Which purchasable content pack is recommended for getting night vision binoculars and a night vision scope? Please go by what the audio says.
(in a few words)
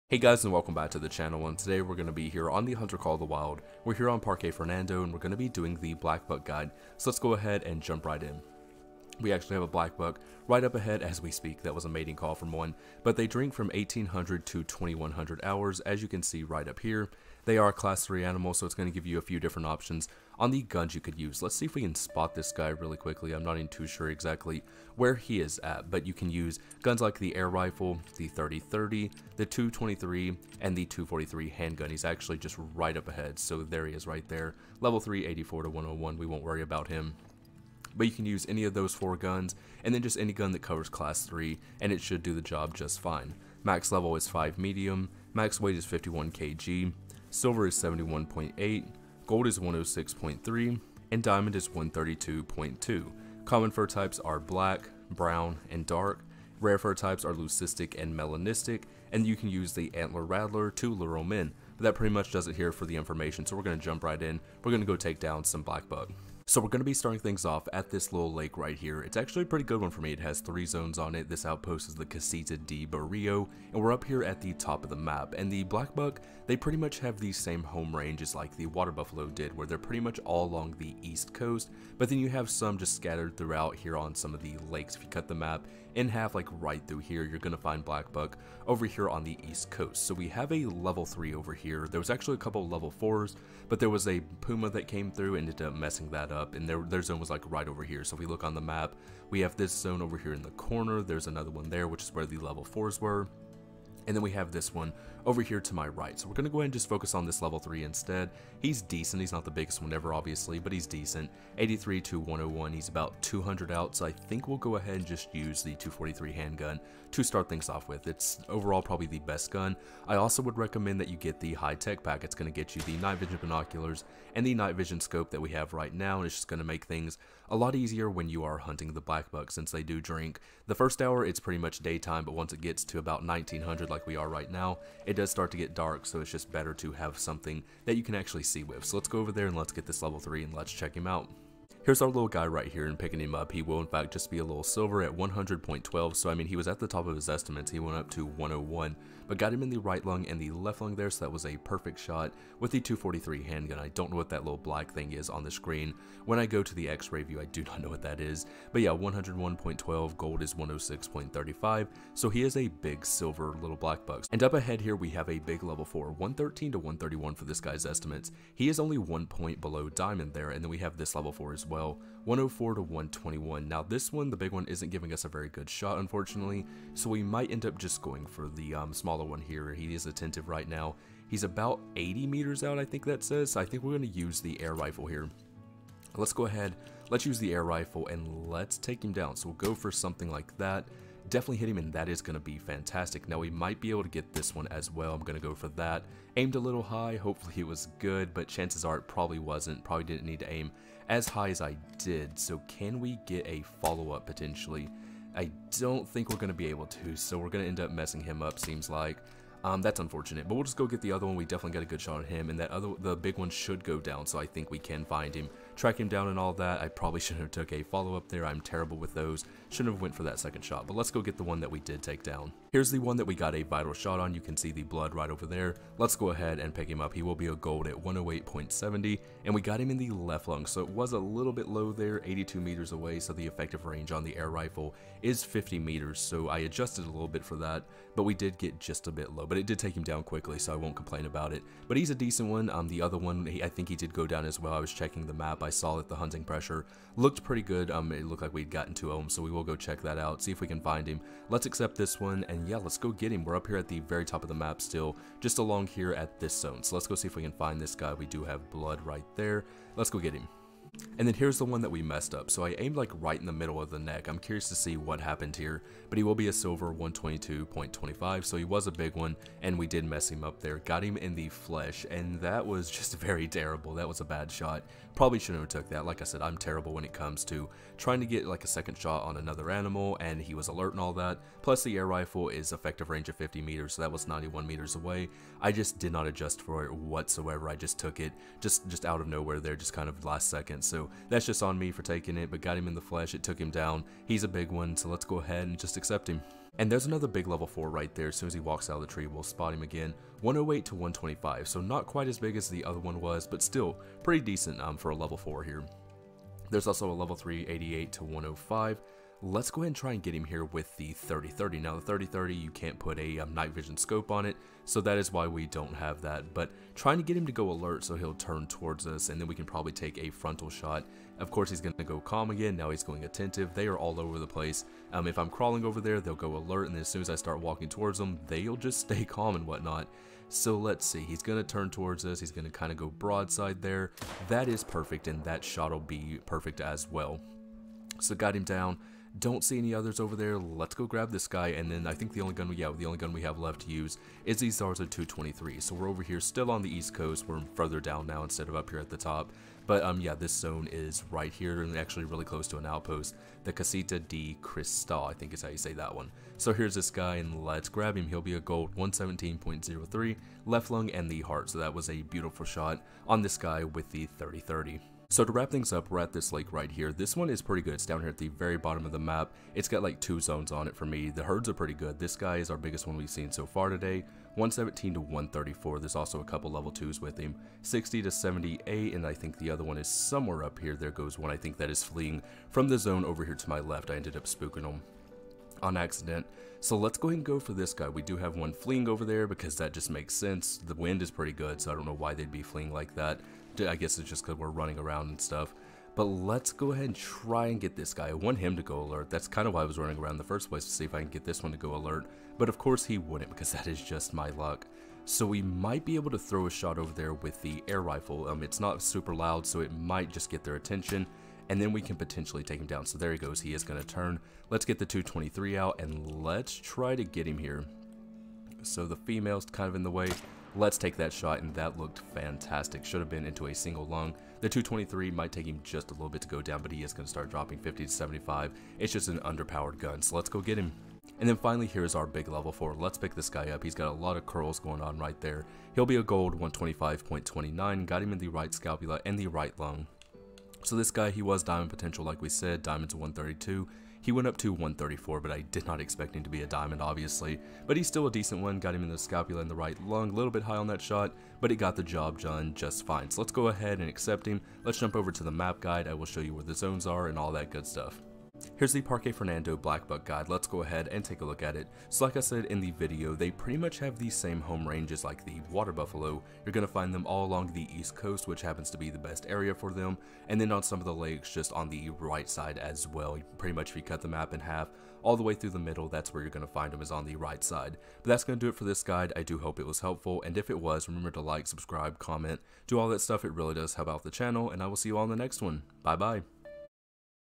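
high-tech pack.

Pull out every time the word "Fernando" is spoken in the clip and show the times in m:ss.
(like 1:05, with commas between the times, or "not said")
0:04, 7:39.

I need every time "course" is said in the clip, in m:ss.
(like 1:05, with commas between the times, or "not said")
5:21, 6:42.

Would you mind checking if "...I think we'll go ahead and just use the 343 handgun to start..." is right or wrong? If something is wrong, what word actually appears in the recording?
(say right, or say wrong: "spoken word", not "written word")
wrong: "243", not "343".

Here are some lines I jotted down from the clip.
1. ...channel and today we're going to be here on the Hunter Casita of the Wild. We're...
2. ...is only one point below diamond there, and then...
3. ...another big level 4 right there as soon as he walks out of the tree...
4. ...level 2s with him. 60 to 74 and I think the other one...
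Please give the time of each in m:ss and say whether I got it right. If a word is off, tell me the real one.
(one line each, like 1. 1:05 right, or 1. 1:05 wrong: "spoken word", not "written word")
1. 0:01 wrong: "Call", not "Casita"
2. 2:48 right
3. 4:57 right
4. 6:16 wrong: "78", not "74".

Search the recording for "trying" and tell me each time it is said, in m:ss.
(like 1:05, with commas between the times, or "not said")
4:37, 5:16.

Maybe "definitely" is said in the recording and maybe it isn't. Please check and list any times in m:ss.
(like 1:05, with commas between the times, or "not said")
3:11, 3:31.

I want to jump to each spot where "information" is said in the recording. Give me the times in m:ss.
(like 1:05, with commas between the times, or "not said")
1:02.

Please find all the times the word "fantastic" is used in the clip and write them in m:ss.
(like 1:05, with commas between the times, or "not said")
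3:12, 7:02.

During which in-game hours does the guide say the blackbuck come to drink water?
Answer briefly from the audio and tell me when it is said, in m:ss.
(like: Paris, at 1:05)
1800 to 2100, at 0:13.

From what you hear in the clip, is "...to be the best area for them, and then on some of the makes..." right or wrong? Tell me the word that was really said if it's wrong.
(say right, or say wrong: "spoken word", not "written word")
wrong: "lakes", not "makes".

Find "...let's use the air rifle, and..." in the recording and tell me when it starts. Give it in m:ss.
3:07.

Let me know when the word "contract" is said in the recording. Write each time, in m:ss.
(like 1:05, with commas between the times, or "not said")
not said.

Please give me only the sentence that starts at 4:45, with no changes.
I just did not adjust for it whatsoever.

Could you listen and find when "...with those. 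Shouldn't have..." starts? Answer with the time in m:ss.
3:38.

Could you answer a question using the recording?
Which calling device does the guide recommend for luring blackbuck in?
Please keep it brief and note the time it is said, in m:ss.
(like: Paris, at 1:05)
antler rattler, at 0:59.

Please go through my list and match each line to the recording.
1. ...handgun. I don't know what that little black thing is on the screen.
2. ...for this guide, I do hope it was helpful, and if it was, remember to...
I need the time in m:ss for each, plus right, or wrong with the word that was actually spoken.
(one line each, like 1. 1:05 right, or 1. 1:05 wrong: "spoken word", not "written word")
1. 2:33 right
2. 7:58 right.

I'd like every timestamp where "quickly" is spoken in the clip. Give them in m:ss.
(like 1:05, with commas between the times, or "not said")
0:22, 4:00.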